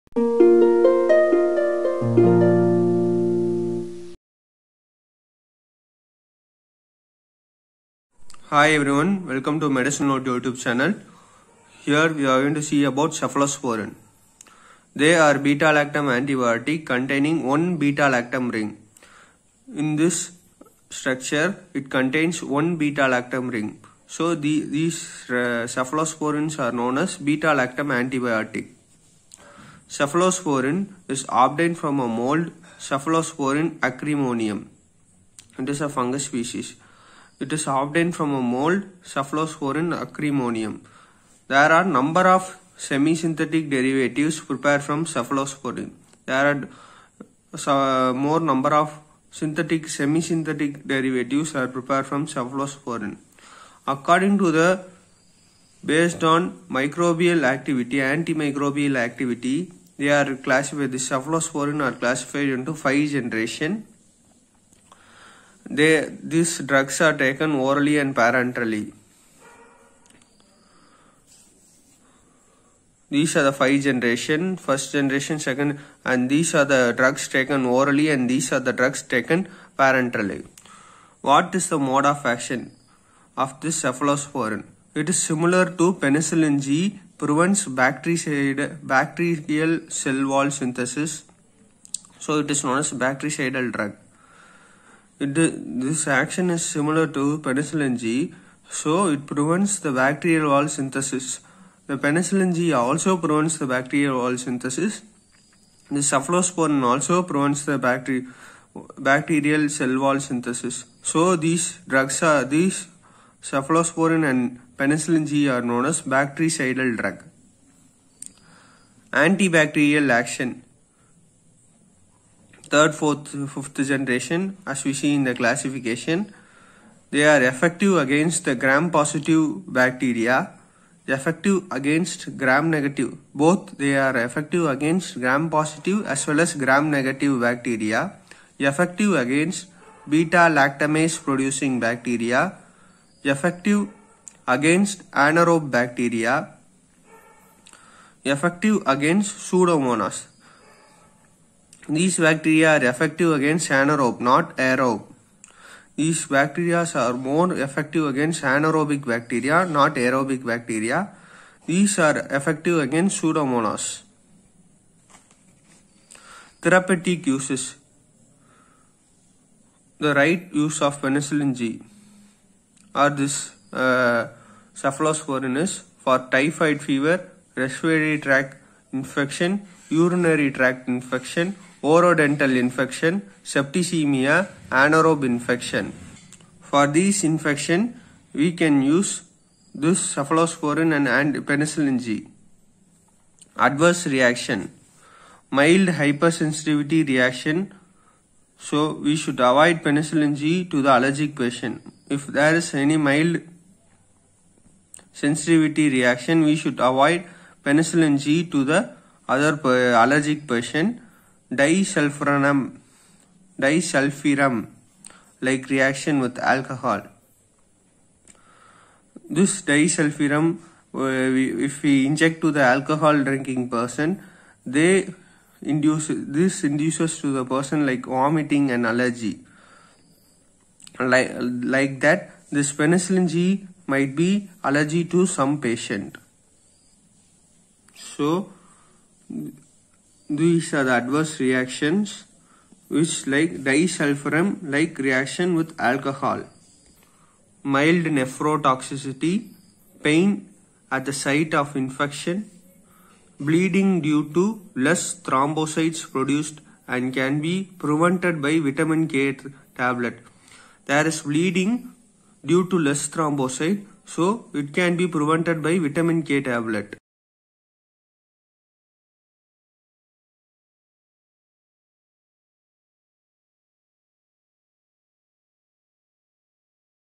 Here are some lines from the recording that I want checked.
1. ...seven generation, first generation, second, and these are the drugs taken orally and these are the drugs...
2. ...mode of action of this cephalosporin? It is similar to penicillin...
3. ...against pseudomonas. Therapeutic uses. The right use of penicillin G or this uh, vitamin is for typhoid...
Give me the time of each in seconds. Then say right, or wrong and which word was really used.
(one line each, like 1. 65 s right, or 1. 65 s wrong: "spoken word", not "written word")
1. 73 s wrong: "five", not "seven"
2. 81 s right
3. 162 s wrong: "cephalosporin", not "vitamin".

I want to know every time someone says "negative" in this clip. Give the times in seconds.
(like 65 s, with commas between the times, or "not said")
132 s, 136 s.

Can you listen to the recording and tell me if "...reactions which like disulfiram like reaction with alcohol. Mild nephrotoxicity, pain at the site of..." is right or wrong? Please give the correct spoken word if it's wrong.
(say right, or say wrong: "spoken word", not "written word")
right.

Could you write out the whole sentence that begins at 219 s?
This disulfiram, uh, if we inject to the alcohol drinking person, they induce this induces to the person like vomiting and allergy.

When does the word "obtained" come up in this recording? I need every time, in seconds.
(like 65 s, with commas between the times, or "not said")
31 s, 37 s.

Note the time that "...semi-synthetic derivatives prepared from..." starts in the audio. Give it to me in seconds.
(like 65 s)
42 s.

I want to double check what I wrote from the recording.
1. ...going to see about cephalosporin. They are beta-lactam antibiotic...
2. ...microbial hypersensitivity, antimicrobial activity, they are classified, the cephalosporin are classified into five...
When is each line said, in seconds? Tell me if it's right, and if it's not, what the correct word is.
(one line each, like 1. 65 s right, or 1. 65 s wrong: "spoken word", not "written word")
1. 12 s right
2. 56 s wrong: "activity", not "hypersensitivity".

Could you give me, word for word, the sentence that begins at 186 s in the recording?
For these infection, we can use this cephalosporin and, and penicillin G.